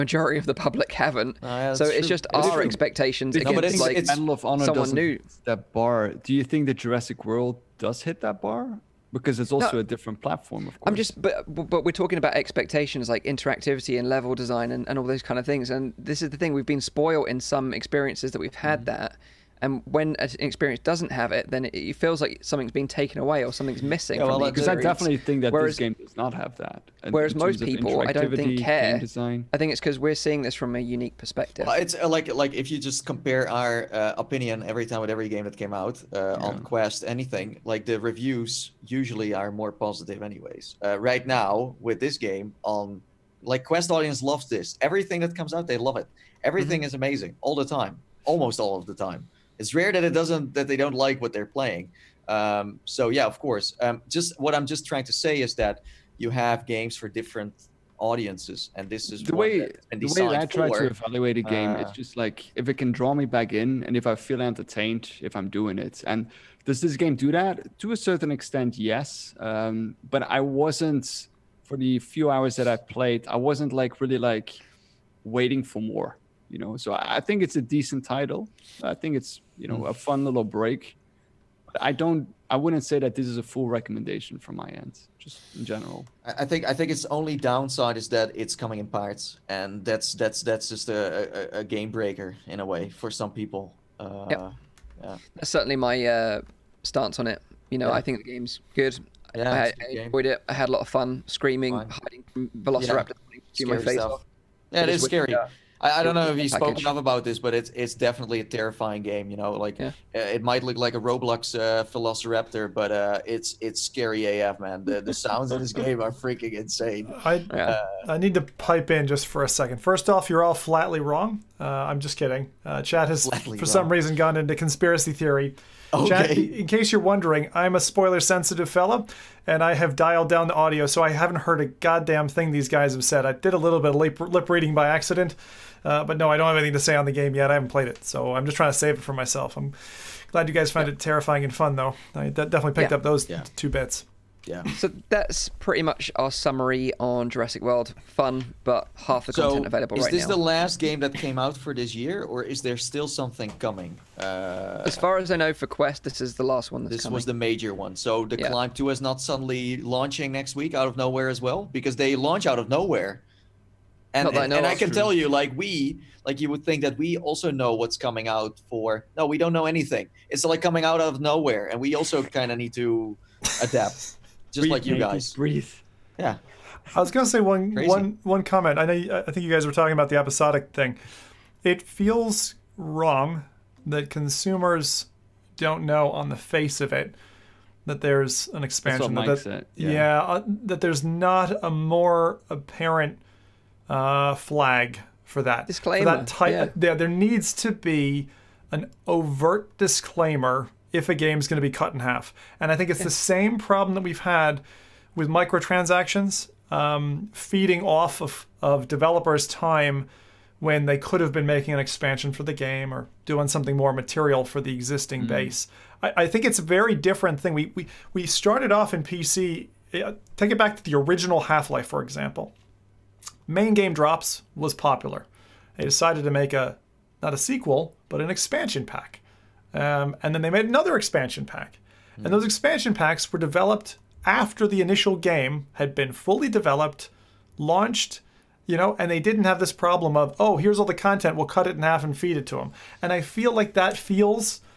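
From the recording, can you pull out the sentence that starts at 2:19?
I'm glad you guys found yeah.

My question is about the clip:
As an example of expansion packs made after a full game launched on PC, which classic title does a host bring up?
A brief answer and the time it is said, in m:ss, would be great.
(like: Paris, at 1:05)
Half Life, at 3:41.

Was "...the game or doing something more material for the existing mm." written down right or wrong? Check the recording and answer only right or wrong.
right.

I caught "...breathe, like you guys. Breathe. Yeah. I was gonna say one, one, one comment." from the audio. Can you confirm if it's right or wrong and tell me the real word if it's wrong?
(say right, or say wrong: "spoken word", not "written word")
right.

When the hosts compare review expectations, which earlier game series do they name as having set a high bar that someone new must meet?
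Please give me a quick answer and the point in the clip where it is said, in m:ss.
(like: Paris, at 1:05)
Medal of Honor, at 0:04.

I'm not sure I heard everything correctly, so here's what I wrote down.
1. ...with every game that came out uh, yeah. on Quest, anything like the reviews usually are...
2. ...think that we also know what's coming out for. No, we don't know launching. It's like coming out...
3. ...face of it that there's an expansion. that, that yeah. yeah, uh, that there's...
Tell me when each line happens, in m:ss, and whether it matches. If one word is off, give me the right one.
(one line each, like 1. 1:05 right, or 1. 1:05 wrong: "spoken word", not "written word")
1. 0:35 right
2. 2:46 wrong: "anything", not "launching"
3. 3:06 right.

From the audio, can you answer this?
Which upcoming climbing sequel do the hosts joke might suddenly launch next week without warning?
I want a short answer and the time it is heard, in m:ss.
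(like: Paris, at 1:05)
Climb Two, at 2:38.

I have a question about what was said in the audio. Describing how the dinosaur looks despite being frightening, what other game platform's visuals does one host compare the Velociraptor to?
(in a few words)
Roblox.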